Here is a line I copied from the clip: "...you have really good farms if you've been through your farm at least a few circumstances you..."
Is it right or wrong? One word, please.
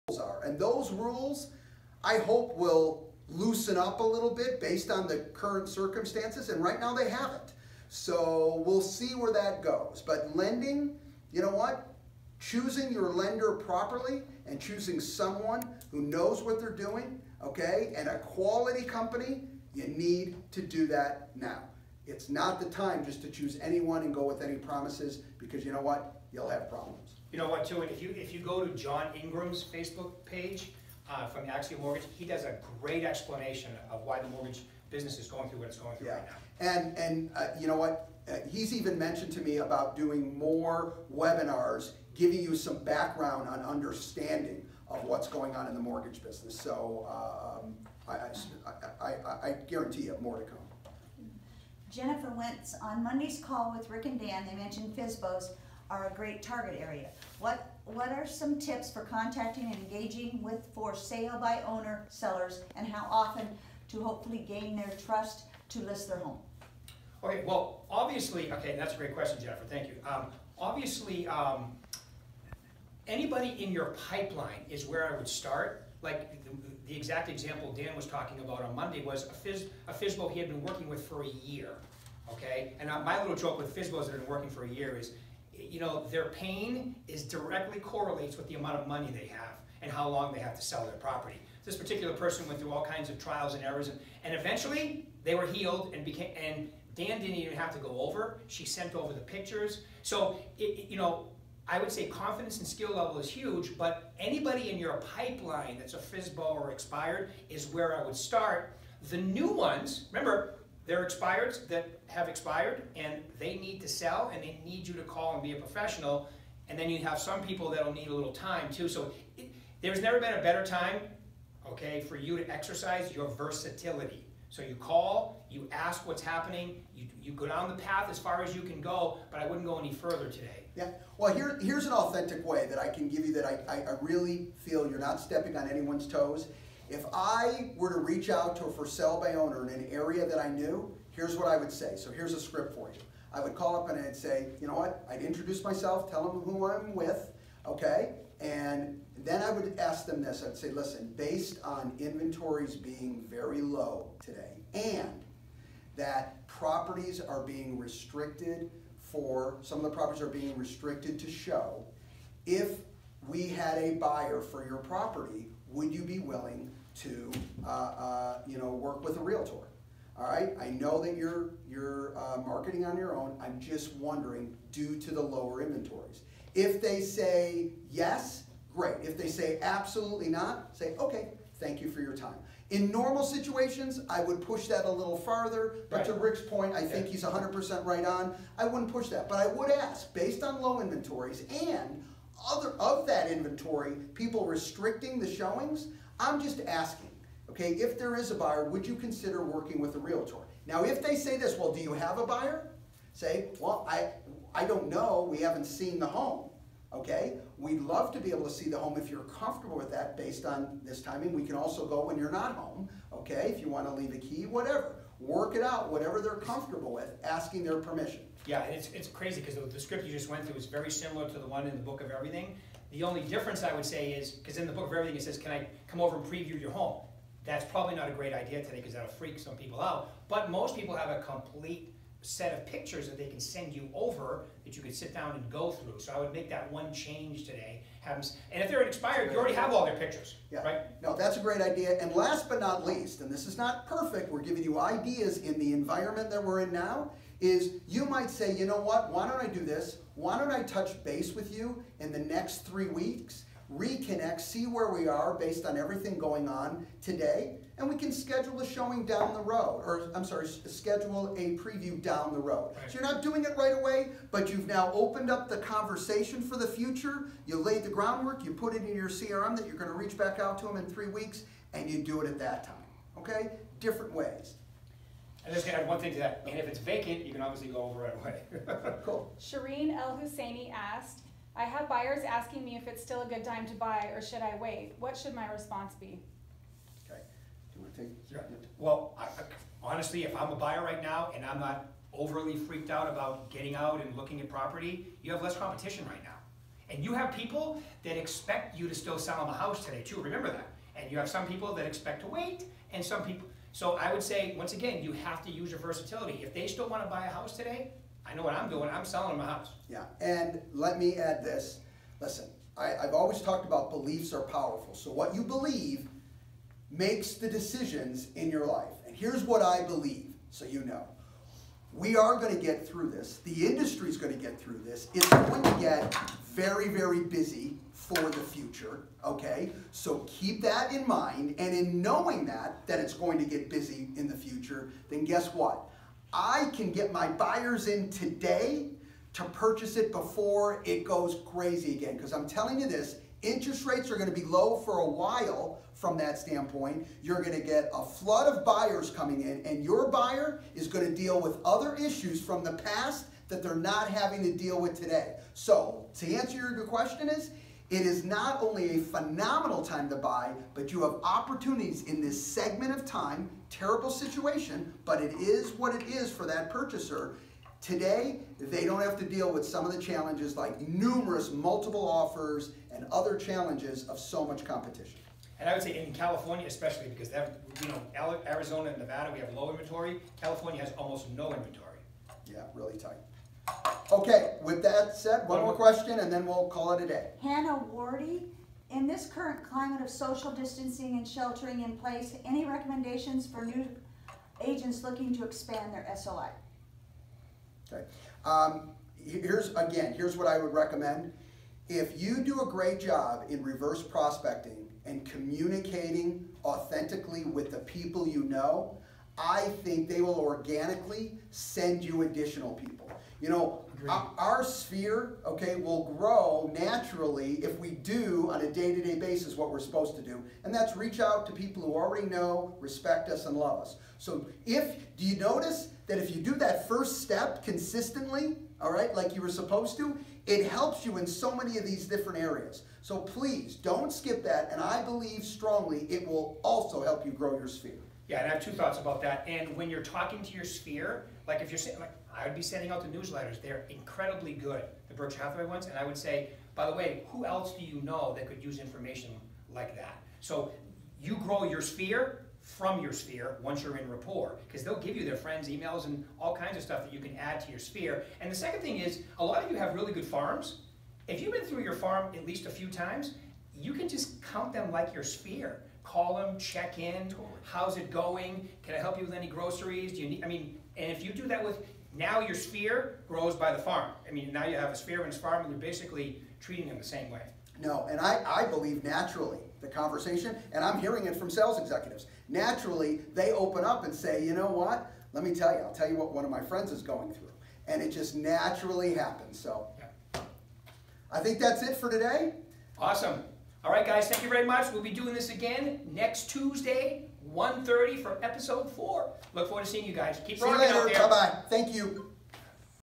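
wrong.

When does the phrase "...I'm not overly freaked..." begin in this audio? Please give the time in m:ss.
4:51.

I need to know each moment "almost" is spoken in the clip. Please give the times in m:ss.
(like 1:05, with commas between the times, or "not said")
6:20.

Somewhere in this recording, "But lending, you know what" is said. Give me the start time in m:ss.
0:10.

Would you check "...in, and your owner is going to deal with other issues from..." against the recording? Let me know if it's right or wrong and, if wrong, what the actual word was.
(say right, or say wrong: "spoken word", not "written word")
wrong: "buyer", not "owner".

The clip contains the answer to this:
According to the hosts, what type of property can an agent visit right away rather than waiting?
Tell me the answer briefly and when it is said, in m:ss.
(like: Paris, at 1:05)
vacant, at 4:36.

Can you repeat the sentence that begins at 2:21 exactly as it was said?
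So here's a script for you.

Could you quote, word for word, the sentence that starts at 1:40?
So, it, you know, I would say confidence and skill level is huge.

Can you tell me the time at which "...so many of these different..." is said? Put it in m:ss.
7:11.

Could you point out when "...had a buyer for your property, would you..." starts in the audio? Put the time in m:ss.
2:43.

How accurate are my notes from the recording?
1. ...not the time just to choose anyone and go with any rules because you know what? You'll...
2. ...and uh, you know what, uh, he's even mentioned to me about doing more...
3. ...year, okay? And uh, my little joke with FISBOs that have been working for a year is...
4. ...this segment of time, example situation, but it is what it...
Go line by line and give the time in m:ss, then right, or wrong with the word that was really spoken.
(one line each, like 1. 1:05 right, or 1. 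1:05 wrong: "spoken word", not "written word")
1. 0:22 wrong: "promises", not "rules"
2. 0:36 right
3. 1:21 right
4. 6:02 wrong: "terrible", not "example".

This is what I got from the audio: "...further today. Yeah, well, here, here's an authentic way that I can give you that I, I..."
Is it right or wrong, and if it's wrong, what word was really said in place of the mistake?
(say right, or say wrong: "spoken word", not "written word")
right.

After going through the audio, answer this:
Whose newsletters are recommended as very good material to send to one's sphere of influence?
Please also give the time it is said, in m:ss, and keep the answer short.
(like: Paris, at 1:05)
Berkshire Hathaway, at 7:25.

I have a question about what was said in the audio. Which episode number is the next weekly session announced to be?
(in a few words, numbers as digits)
4.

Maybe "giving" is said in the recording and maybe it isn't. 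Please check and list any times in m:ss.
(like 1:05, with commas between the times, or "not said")
0:42, 4:04.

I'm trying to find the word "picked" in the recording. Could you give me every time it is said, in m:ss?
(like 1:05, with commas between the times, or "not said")
not said.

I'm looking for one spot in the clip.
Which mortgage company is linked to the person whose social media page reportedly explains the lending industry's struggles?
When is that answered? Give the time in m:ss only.
0:31.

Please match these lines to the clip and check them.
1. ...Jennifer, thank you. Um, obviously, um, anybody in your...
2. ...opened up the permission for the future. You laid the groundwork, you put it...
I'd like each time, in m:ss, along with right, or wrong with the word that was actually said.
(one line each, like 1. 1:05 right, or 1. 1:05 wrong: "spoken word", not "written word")
1. 1:09 right
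2. 4:24 wrong: "conversation", not "permission".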